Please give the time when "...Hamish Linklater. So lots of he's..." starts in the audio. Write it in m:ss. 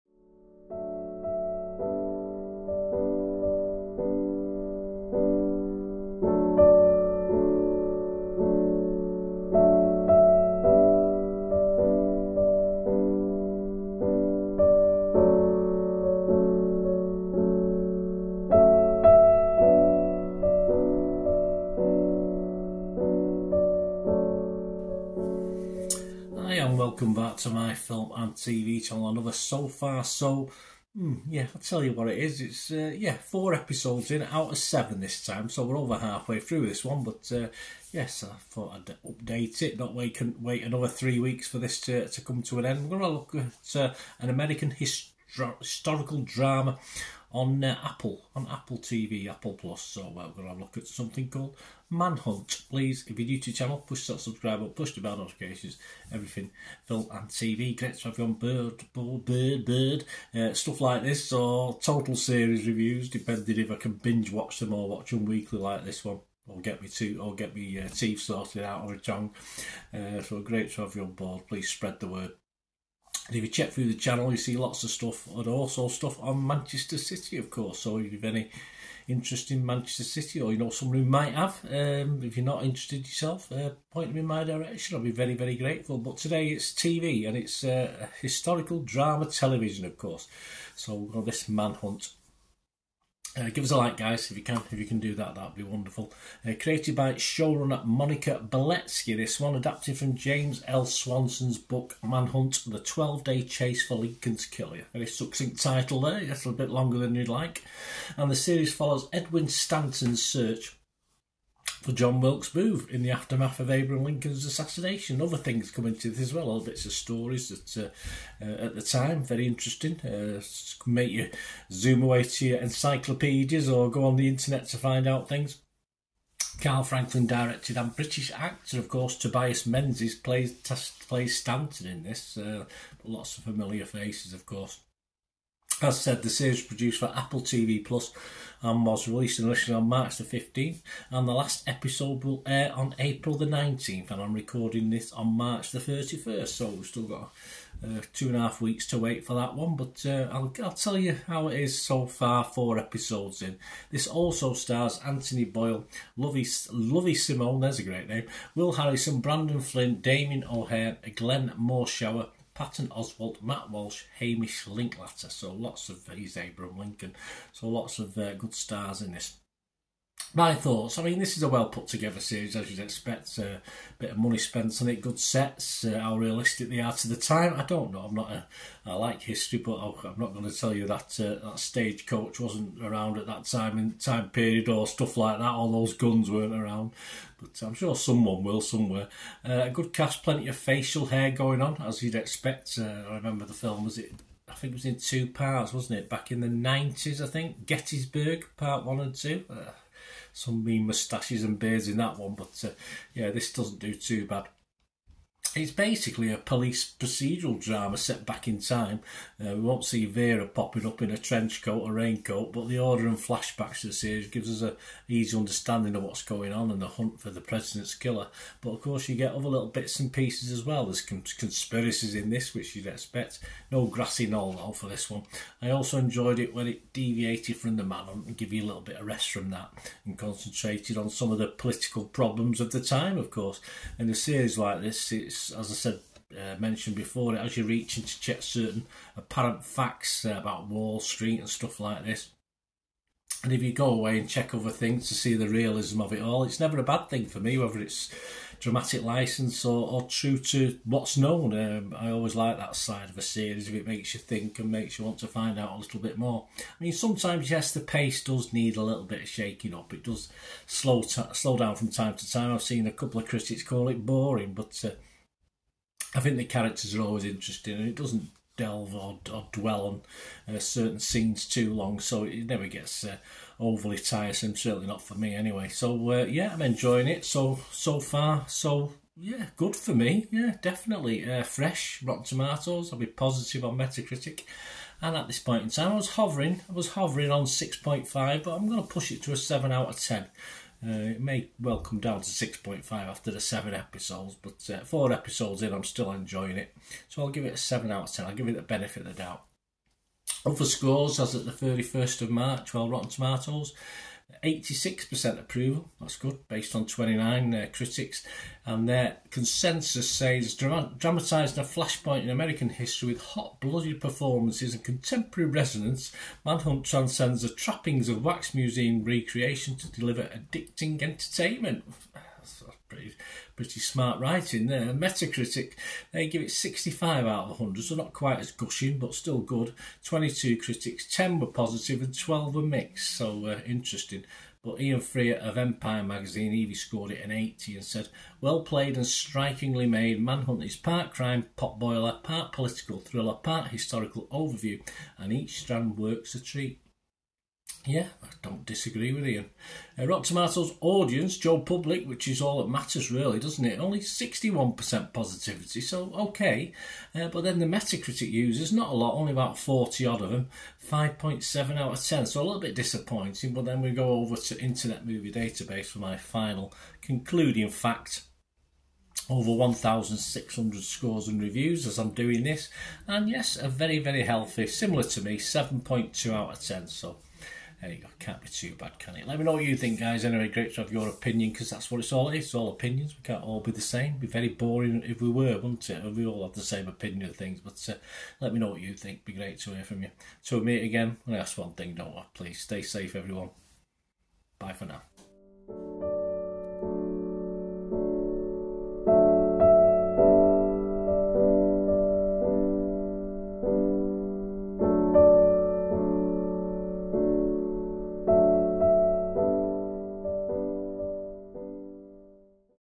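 2:44.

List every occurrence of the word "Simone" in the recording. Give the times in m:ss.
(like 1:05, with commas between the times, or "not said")
2:37.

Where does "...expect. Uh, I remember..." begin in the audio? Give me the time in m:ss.
3:12.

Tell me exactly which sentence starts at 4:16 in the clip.
I mean, sometimes, yes, the pace does need a little bit of shaking up.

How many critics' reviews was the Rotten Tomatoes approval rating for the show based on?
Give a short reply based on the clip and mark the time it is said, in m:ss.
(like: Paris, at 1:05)
29, at 5:06.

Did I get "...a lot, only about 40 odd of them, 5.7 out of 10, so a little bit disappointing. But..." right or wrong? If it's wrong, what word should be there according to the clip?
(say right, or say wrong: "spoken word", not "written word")
right.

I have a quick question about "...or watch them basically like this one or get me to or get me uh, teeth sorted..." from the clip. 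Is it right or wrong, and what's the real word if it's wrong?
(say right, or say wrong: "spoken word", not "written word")
wrong: "weekly", not "basically".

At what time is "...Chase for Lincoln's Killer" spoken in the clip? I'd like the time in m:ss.
1:43.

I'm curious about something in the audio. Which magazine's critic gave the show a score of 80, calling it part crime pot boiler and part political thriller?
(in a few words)
Empire.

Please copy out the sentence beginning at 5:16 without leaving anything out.
Manhunt transcends the trappings of wax museum recreation to deliver addicting entertainment.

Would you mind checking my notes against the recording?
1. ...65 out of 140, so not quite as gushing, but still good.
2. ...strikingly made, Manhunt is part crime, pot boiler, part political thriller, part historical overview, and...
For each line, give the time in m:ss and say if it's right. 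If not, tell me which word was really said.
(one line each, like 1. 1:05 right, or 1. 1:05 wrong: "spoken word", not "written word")
1. 5:26 wrong: "100", not "140"
2. 5:39 right.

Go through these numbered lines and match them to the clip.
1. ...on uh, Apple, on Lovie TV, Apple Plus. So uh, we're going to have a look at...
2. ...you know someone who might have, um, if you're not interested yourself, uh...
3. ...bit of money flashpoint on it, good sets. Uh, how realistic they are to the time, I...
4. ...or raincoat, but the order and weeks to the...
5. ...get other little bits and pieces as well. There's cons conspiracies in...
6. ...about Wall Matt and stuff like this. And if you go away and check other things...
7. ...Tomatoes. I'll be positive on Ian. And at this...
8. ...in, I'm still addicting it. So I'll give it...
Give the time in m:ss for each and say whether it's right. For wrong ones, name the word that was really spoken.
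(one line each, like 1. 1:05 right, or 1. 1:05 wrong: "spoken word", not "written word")
1. 0:47 wrong: "Apple", not "Lovie"
2. 1:20 right
3. 2:53 wrong: "spent", not "flashpoint"
4. 3:31 wrong: "flashbacks", not "weeks"
5. 3:39 right
6. 4:00 wrong: "Street", not "Matt"
7. 4:42 wrong: "Metacritic", not "Ian"
8. 4:55 wrong: "enjoying", not "addicting".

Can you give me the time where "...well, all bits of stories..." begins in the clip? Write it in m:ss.
1:56.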